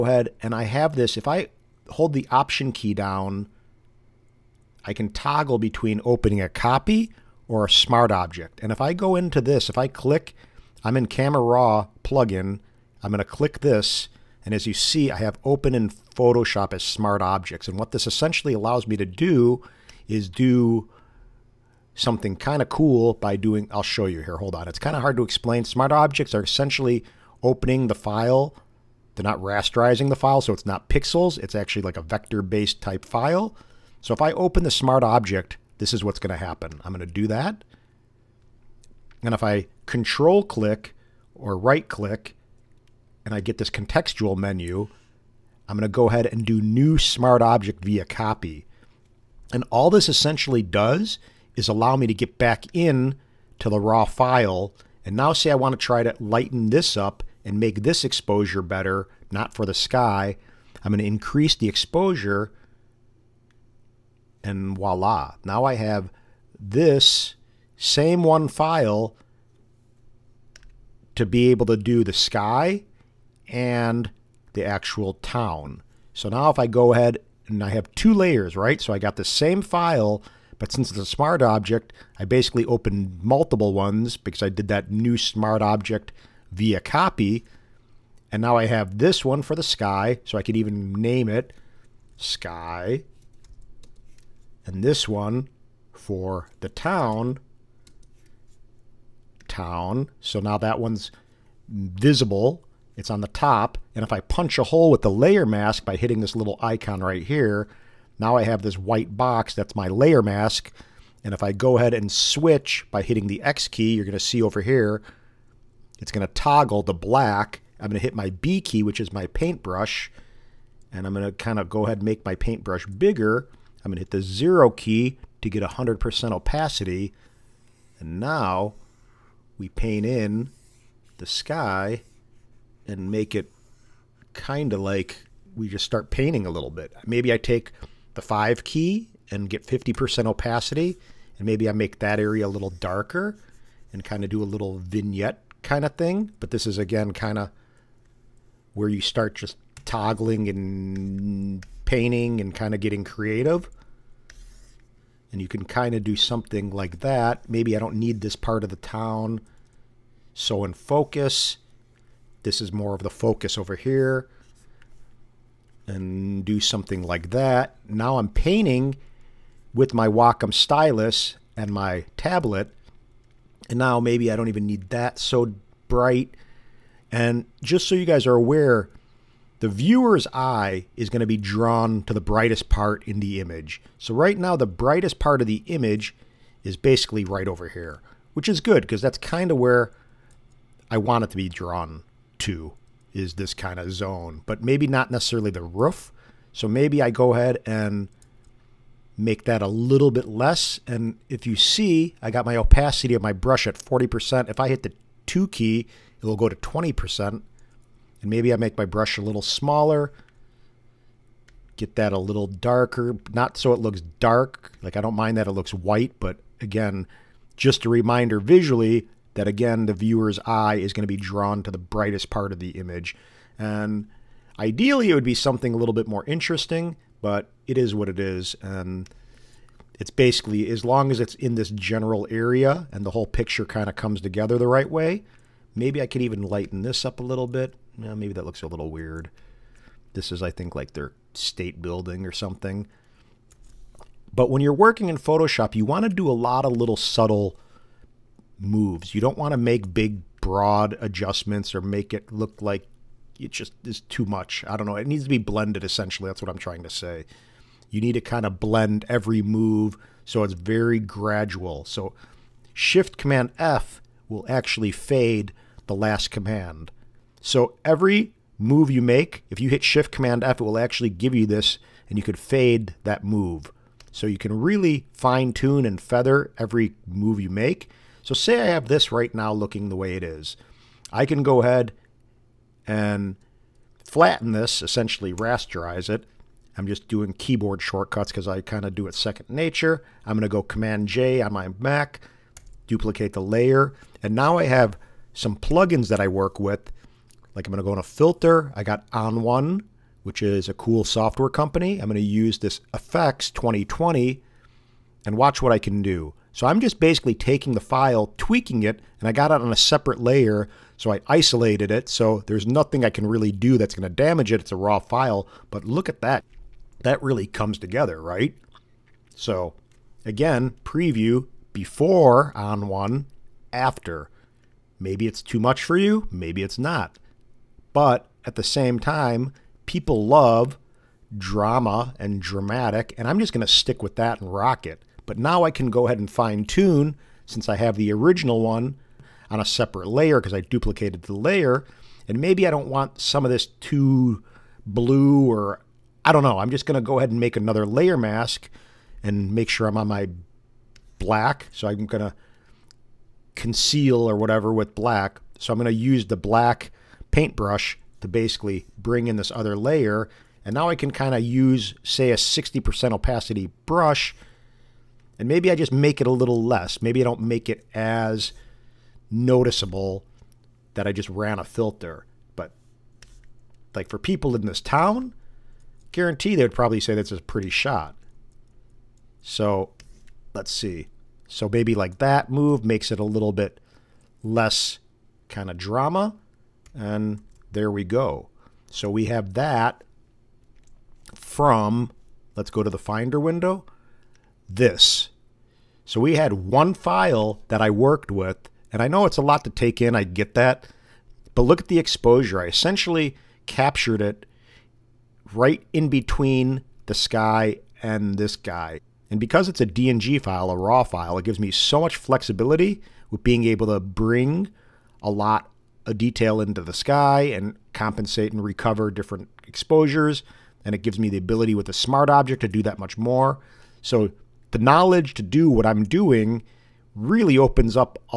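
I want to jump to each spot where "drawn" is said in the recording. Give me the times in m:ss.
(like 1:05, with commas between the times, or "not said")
3:01, 3:11, 3:41.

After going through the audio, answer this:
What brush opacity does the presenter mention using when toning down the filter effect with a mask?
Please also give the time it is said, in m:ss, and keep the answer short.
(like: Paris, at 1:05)
60%, at 6:02.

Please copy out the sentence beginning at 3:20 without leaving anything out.
And if you see, I got my opacity of my brush at 40%.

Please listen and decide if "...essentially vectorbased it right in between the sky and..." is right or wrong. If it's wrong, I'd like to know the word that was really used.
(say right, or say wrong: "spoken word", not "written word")
wrong: "captured", not "vectorbased".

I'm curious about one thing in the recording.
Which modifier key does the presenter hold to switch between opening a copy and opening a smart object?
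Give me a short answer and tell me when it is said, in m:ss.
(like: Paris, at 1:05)
Option, at 0:02.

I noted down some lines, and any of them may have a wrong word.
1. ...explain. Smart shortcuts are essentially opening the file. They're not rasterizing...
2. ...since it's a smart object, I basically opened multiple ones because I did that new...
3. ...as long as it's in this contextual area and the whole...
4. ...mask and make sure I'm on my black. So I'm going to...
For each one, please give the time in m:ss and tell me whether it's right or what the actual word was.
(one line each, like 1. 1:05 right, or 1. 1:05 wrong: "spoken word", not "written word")
1. 0:25 wrong: "objects", not "shortcuts"
2. 1:20 right
3. 3:50 wrong: "general", not "contextual"
4. 5:48 right.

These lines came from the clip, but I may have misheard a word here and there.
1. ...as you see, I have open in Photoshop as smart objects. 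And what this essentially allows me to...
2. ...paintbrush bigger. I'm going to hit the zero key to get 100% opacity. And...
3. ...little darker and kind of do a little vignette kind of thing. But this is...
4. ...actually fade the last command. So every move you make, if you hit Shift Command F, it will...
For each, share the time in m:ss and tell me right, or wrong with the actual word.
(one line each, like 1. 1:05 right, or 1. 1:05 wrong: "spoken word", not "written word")
1. 0:14 right
2. 2:02 right
3. 2:22 right
4. 4:24 right.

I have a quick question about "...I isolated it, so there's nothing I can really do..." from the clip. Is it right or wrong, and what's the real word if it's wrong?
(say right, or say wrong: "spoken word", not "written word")
right.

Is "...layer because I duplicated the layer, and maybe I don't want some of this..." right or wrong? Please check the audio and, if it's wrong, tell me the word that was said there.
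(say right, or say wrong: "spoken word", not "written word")
right.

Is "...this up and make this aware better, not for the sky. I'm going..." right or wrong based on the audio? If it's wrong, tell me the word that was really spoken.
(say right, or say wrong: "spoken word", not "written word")
wrong: "exposure", not "aware".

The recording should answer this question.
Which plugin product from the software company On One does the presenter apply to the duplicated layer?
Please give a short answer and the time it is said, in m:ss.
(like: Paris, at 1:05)
Effects 2020, at 5:02.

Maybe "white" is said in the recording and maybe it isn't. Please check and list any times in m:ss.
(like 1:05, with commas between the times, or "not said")
1:48, 3:35.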